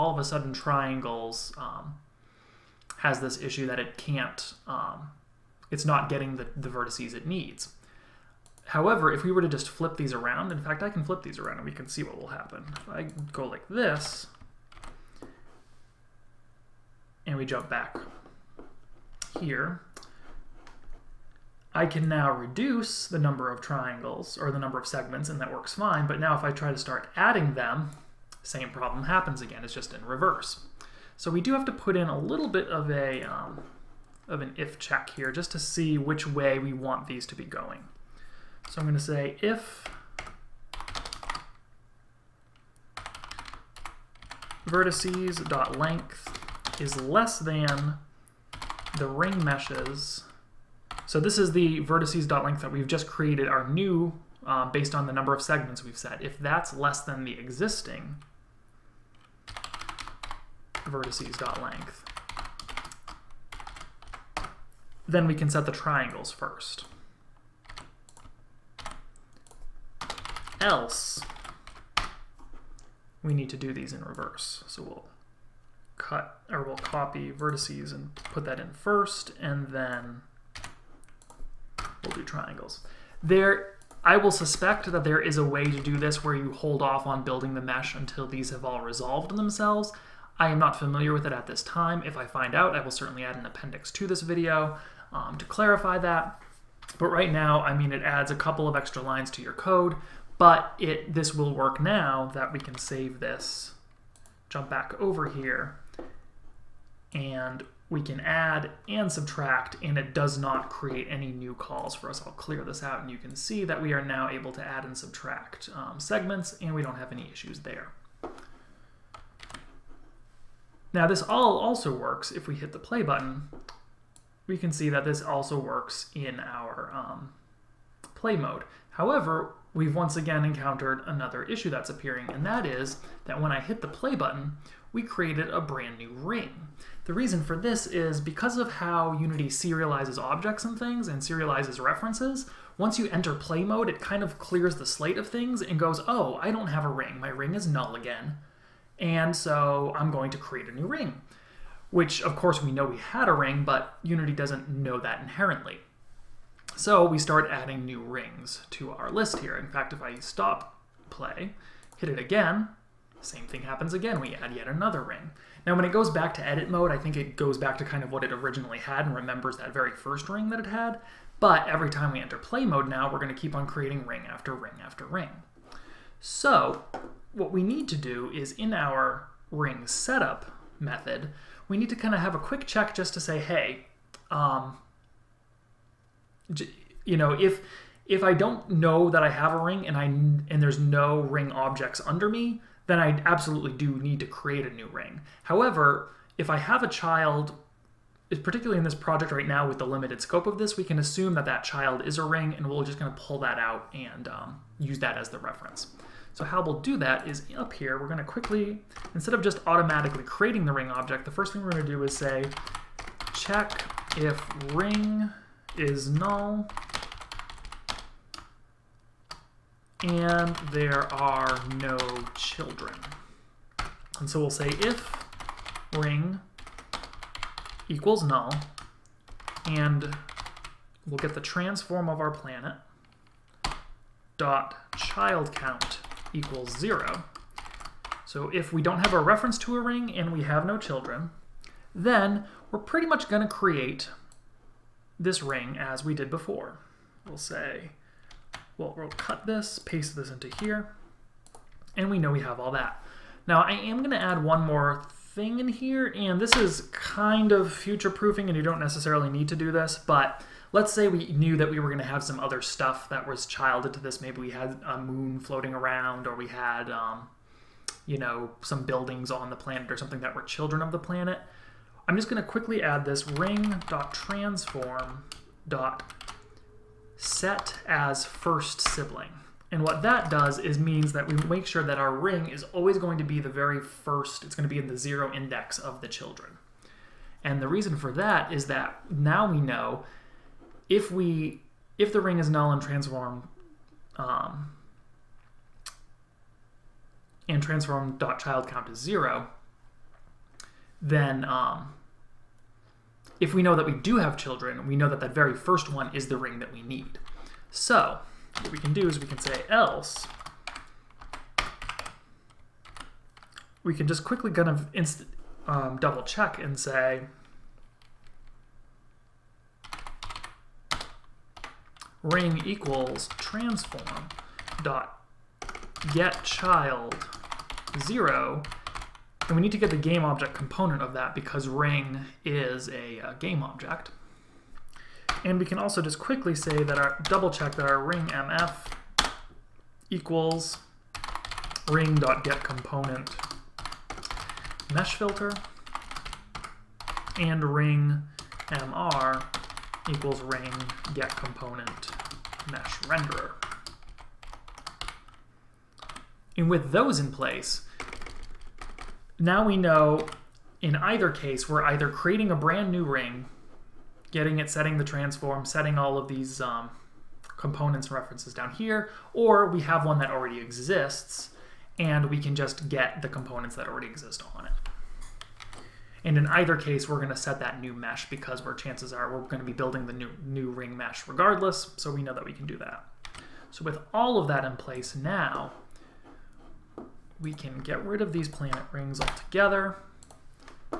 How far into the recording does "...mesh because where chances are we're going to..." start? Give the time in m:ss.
6:17.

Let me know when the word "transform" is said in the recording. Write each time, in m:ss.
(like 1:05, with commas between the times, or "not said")
3:51, 4:52, 4:57, 5:23, 6:05.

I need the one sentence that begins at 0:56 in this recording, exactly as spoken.
If that's less than the existing vertices.length, then we can set the triangles first.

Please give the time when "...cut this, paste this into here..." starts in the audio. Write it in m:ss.
4:09.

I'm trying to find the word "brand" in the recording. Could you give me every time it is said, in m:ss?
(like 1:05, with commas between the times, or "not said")
2:15, 6:02.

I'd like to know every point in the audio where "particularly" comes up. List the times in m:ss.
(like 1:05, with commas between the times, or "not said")
3:18.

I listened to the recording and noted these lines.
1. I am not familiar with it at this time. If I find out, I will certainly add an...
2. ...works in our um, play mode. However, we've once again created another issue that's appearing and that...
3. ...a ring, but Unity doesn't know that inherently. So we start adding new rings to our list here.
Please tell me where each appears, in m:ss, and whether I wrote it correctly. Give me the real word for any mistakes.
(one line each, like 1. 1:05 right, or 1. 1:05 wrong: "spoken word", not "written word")
1. 1:30 right
2. 2:05 wrong: "encountered", not "created"
3. 2:33 right.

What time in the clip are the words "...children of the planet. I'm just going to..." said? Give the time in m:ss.
4:30.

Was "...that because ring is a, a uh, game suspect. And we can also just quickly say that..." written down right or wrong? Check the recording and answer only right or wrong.
wrong.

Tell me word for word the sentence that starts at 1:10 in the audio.
Else, we need to do these in reverse.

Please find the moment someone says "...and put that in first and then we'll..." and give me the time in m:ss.
1:17.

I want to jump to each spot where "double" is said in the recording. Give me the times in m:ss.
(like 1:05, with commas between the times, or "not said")
5:15, 5:37.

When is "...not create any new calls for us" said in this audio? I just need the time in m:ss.
1:50.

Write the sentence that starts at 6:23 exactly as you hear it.
So with all of that in place now, we can get rid of these planet rings altogether.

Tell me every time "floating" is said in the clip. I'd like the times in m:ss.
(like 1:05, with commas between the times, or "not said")
4:25.